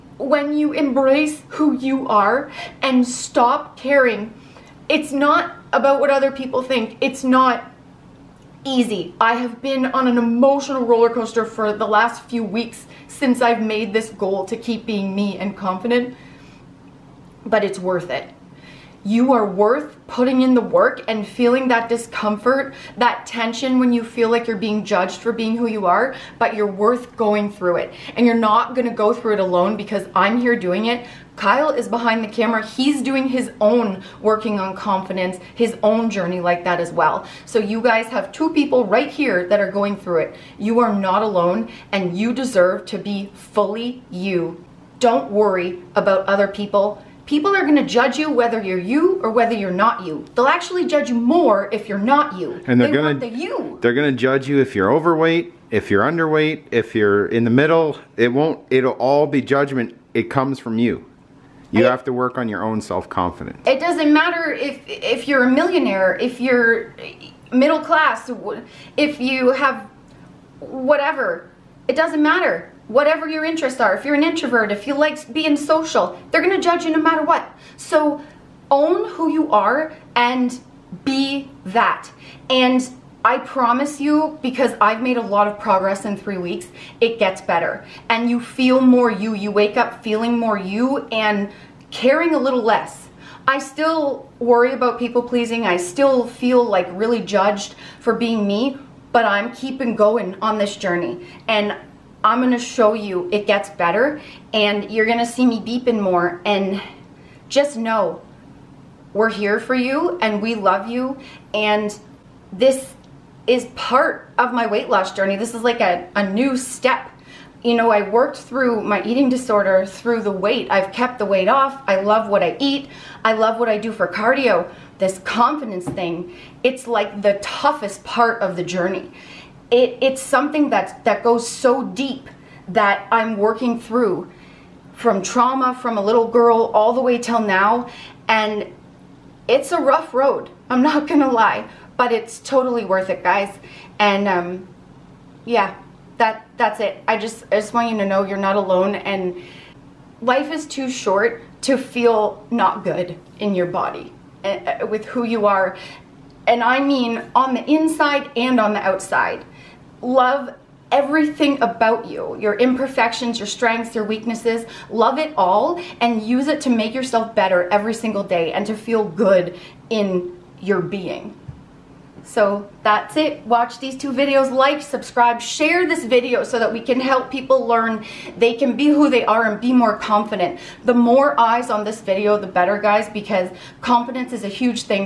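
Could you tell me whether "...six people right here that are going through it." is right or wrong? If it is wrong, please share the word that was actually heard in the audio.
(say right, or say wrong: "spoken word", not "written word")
wrong: "two", not "six".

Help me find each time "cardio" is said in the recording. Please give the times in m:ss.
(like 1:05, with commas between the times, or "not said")
2:04.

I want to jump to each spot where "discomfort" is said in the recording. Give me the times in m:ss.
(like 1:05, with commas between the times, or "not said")
0:21.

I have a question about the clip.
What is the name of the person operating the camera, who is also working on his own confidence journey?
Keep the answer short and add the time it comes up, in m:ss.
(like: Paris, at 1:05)
Kyle, at 0:31.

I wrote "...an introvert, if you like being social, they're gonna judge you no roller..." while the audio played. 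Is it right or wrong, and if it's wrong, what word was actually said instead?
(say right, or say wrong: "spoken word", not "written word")
wrong: "matter", not "roller".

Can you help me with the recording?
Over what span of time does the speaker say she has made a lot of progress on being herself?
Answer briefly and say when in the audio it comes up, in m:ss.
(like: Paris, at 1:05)
3 weeks, at 1:26.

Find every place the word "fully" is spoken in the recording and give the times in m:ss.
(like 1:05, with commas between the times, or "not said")
0:43.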